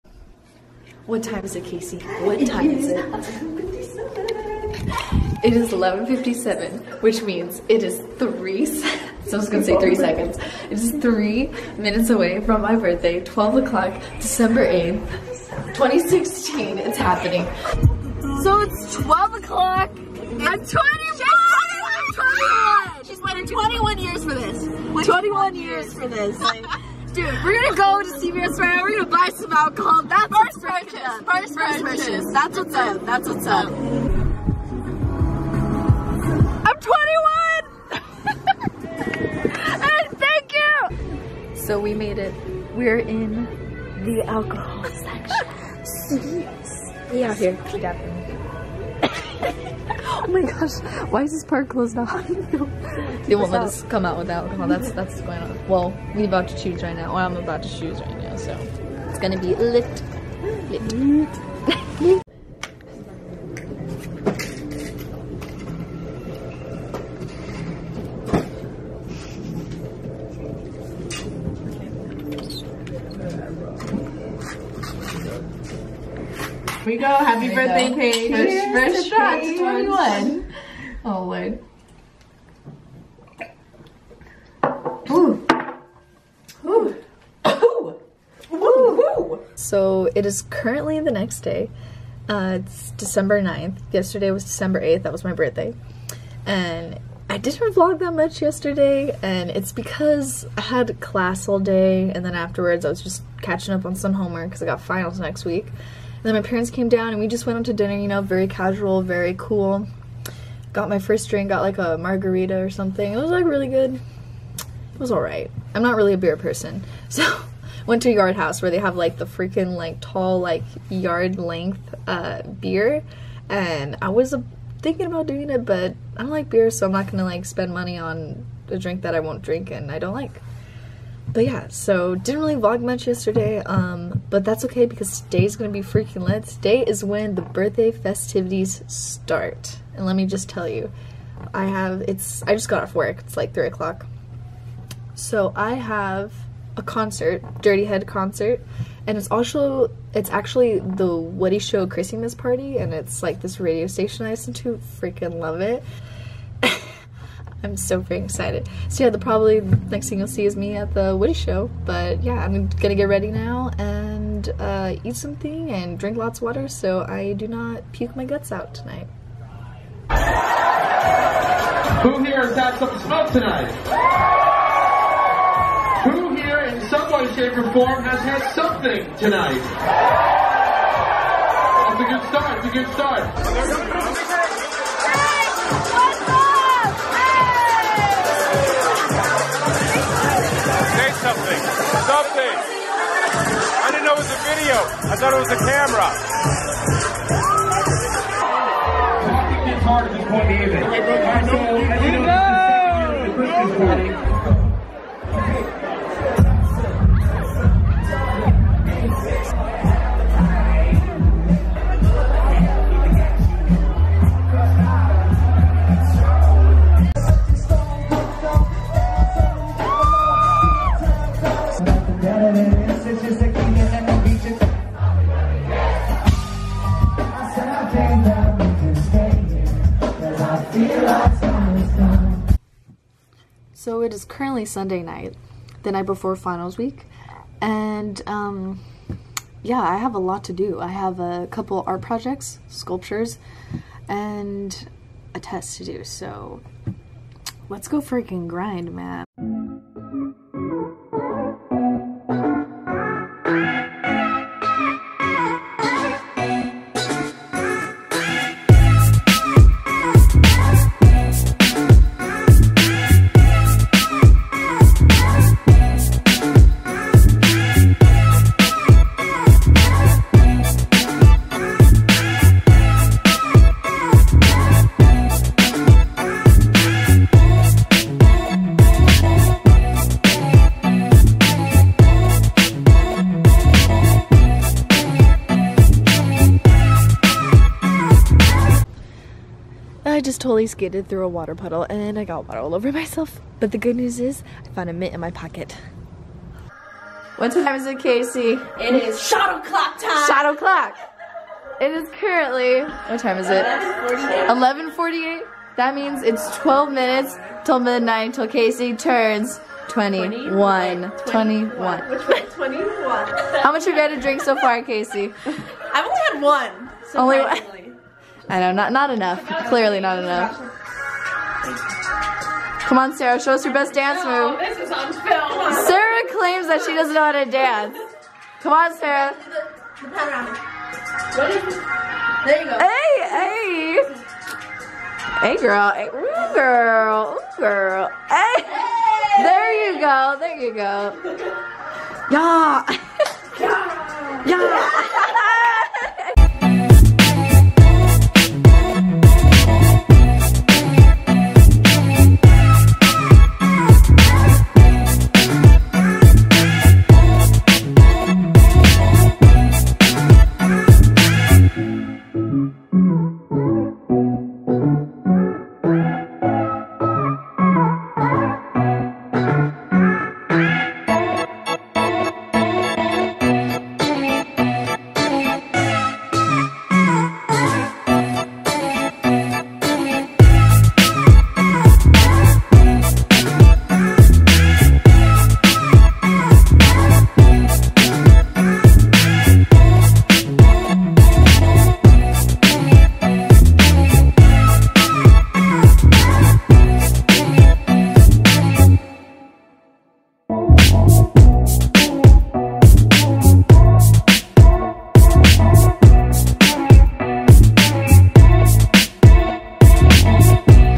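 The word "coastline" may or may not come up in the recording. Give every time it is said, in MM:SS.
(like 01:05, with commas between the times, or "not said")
not said.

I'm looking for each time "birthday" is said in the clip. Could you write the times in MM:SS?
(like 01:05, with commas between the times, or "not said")
00:12, 01:17, 01:35, 02:17.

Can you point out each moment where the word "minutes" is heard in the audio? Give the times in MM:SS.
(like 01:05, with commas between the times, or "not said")
00:11, 05:06.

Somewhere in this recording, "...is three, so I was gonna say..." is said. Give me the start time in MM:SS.
00:07.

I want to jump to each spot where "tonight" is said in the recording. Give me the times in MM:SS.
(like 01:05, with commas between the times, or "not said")
02:48, 02:53, 02:59.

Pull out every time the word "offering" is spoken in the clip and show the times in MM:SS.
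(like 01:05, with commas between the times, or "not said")
not said.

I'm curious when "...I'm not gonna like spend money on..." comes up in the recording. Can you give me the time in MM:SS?
02:06.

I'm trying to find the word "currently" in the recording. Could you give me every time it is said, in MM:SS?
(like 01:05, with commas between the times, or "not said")
01:30, 03:54, 05:02.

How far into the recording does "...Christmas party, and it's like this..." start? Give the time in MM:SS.
02:31.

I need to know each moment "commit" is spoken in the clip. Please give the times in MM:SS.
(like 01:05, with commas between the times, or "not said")
not said.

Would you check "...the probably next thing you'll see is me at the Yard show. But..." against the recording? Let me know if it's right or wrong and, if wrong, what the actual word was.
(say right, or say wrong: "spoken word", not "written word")
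wrong: "Woody", not "Yard".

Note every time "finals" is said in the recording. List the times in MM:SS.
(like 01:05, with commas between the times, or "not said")
01:44, 03:56.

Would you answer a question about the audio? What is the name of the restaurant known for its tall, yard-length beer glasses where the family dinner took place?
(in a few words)
Yard House.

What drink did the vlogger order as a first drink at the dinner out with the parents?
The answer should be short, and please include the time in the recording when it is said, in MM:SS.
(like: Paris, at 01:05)
margarita, at 01:51.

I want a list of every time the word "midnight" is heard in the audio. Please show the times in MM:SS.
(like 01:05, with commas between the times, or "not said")
05:07.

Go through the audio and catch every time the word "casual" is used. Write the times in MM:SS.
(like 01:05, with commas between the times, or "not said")
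01:48.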